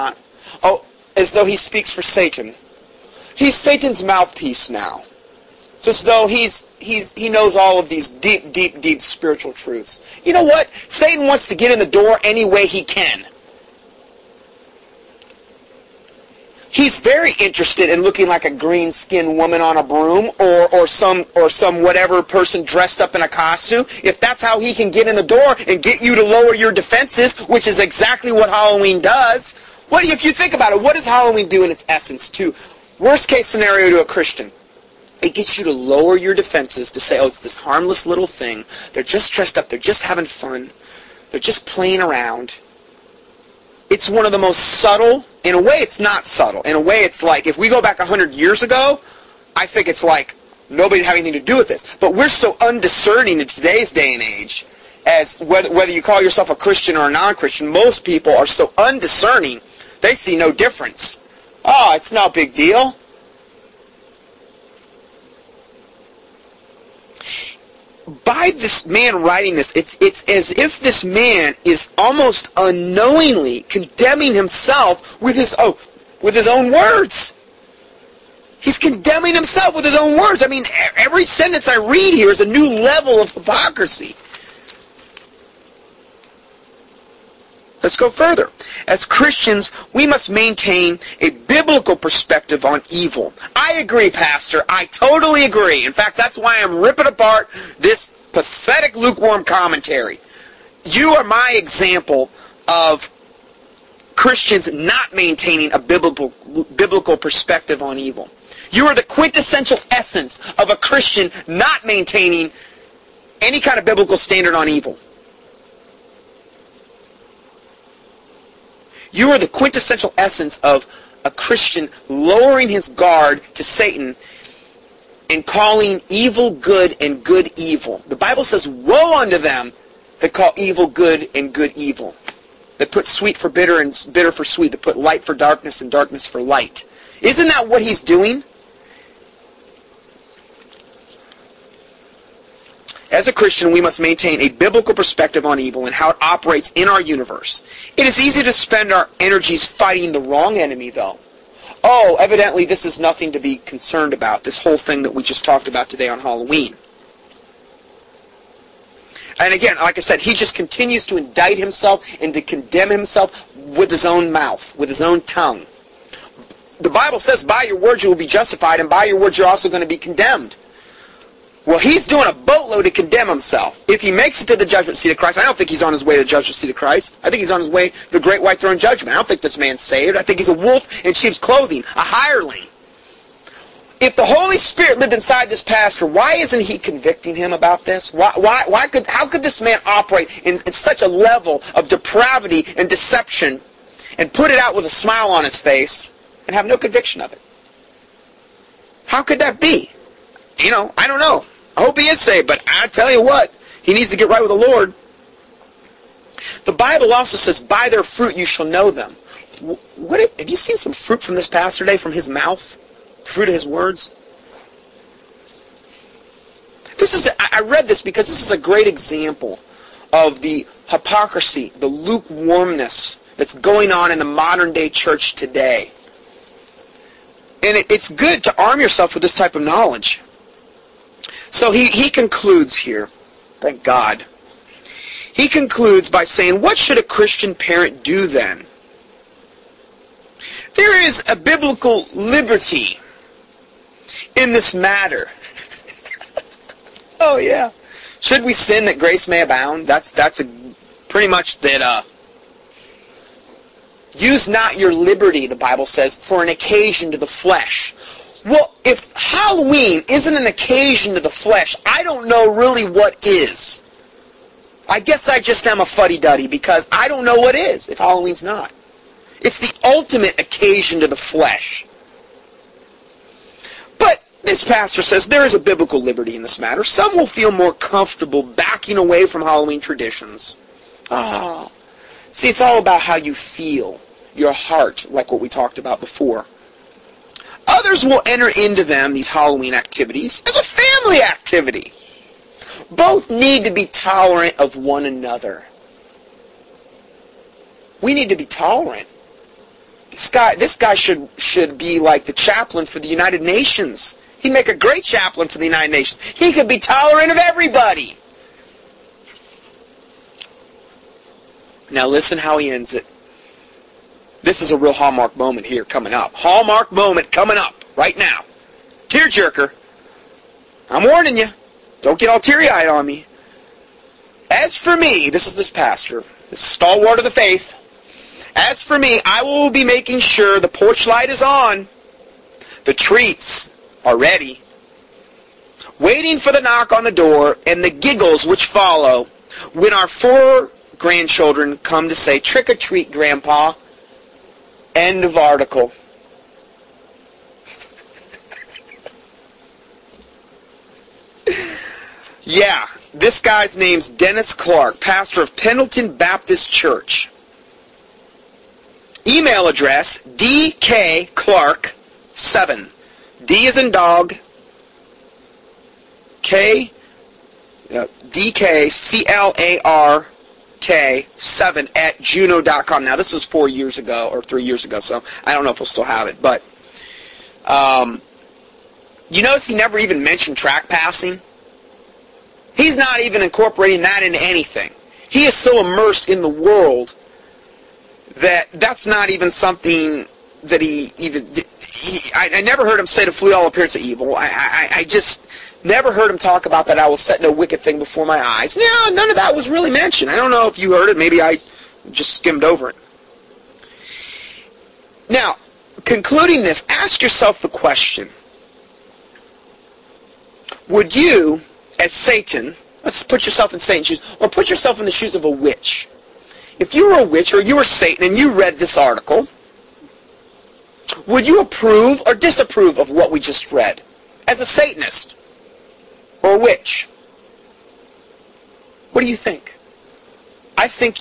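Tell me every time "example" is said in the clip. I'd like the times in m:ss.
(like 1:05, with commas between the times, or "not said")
1:41, 3:38.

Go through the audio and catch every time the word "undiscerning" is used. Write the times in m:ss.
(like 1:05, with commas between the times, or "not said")
0:52, 0:58.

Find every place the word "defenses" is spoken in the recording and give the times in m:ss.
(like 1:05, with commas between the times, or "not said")
0:26, 0:36.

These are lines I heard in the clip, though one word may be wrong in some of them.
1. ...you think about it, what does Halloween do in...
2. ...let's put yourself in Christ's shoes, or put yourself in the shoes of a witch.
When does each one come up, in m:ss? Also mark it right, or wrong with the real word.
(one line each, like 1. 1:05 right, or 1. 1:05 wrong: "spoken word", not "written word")
1. 0:30 right
2. 6:53 wrong: "Satan", not "Christ".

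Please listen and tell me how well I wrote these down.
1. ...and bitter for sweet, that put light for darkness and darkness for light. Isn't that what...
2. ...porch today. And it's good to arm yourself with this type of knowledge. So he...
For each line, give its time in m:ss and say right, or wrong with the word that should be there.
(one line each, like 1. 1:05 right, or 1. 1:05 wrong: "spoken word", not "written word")
1. 2:13 right
2. 3:44 wrong: "church", not "porch".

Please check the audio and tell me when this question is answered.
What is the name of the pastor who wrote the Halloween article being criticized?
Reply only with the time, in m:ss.
5:54.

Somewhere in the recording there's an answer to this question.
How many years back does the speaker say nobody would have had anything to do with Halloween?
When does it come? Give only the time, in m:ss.
0:47.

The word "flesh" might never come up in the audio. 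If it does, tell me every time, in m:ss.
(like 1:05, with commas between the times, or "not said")
4:17, 4:21, 4:31.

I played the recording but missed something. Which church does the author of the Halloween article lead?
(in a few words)
Pendleton Baptist Church.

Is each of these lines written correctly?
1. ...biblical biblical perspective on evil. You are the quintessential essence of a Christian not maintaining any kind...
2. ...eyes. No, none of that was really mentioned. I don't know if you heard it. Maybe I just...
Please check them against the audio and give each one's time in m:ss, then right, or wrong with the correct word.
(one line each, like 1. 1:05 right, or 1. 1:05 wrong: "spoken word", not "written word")
1. 1:45 right
2. 6:38 right.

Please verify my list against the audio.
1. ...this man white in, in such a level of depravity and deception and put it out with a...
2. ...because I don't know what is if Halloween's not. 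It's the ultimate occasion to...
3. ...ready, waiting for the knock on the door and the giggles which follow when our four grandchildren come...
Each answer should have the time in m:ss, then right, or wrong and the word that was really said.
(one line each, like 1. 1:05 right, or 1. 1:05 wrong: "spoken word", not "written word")
1. 3:09 wrong: "operate", not "white"
2. 4:26 right
3. 5:34 right.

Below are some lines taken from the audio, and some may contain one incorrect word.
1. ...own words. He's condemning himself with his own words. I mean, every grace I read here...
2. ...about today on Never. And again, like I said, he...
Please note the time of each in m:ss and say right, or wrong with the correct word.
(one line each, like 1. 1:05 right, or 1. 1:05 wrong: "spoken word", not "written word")
1. 1:16 wrong: "sentence", not "grace"
2. 2:35 wrong: "Halloween", not "Never".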